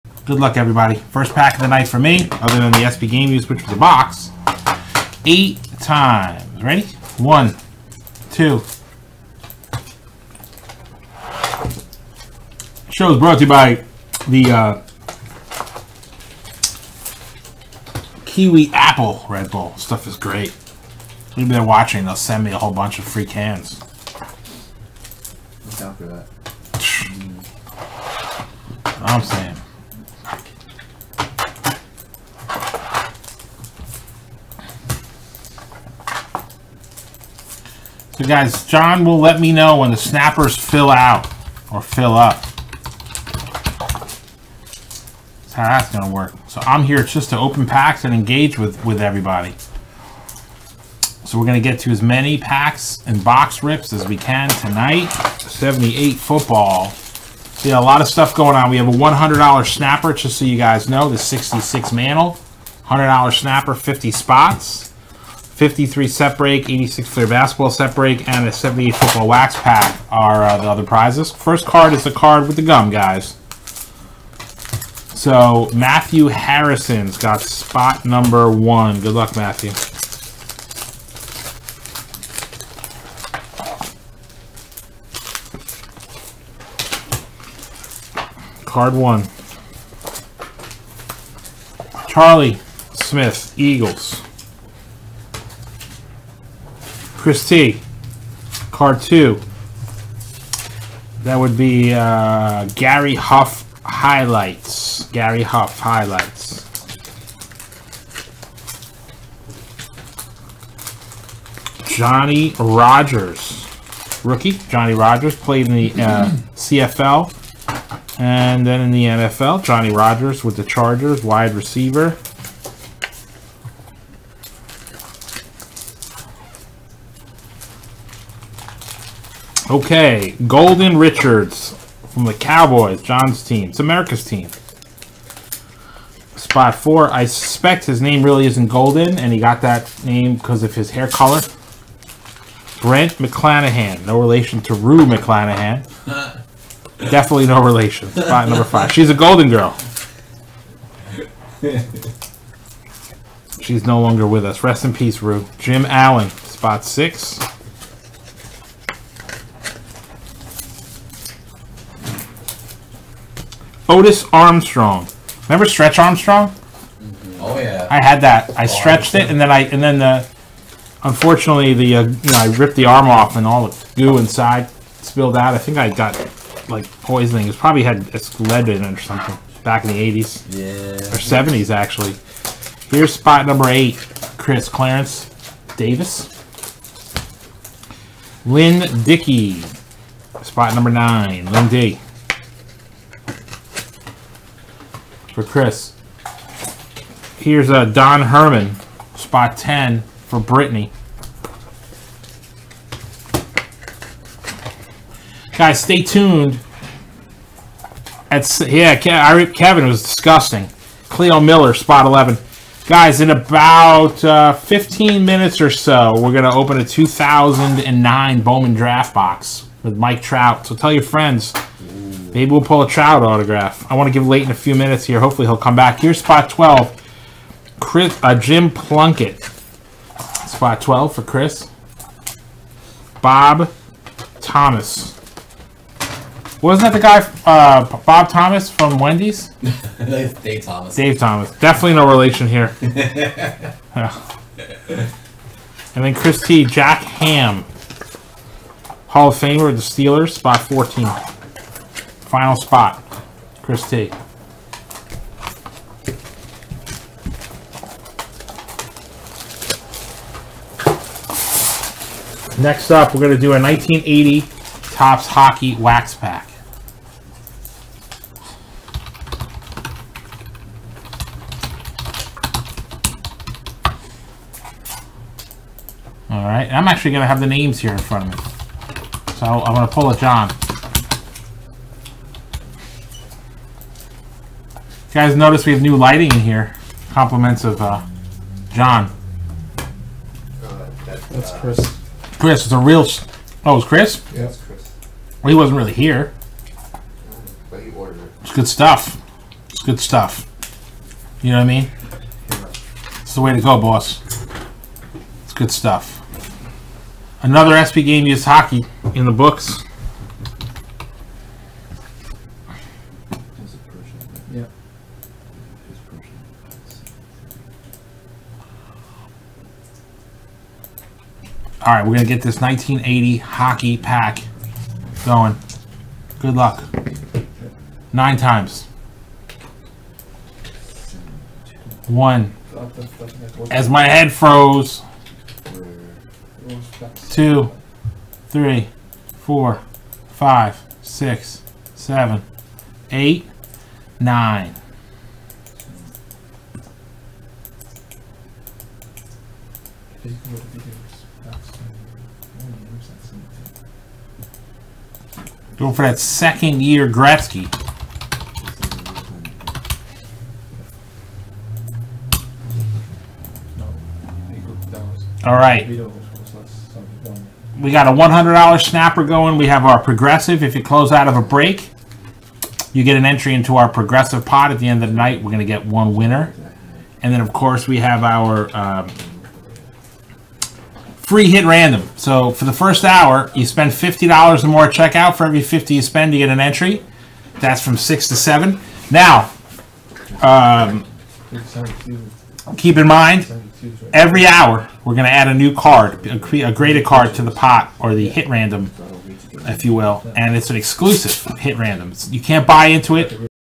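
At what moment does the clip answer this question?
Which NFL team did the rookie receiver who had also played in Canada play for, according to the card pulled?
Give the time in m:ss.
2:00.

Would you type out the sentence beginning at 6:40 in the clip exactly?
And it's an exclusive hit random.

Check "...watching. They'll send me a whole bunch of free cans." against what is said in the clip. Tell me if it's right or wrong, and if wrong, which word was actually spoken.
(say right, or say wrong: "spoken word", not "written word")
right.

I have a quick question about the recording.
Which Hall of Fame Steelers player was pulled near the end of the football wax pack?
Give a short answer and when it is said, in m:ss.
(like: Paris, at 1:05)
Jack Ham, at 4:06.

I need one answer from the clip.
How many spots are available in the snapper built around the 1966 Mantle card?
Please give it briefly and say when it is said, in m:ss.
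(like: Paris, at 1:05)
50, at 1:03.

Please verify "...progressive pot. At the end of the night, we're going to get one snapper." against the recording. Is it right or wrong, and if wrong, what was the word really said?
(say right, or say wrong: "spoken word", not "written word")
wrong: "winner", not "snapper".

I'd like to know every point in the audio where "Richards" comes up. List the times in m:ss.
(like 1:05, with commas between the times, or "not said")
2:10.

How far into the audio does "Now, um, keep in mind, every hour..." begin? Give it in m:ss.
6:29.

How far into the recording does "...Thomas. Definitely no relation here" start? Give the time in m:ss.
4:01.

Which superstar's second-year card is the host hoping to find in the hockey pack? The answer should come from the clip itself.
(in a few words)
Gretzky.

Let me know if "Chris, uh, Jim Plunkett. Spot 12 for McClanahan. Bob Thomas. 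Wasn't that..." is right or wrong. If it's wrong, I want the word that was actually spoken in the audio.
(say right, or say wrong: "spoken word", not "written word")
wrong: "Chris", not "McClanahan".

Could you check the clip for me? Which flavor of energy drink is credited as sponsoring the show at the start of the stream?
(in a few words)
Kiwi Apple.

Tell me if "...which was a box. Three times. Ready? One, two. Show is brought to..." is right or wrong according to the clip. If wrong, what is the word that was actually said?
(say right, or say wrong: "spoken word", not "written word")
wrong: "Eight", not "Three".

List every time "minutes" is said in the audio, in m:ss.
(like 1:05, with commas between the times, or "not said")
3:35, 3:44.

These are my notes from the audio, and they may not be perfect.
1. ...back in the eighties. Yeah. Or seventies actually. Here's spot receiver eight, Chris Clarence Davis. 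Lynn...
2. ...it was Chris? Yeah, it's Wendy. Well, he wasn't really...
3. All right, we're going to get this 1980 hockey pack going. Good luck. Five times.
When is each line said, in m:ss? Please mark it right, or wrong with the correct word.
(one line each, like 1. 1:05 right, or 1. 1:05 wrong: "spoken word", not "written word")
1. 2:59 wrong: "number", not "receiver"
2. 4:53 wrong: "Chris", not "Wendy"
3. 5:21 wrong: "Nine", not "Five".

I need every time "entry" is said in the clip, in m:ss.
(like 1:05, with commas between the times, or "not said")
6:13, 6:26.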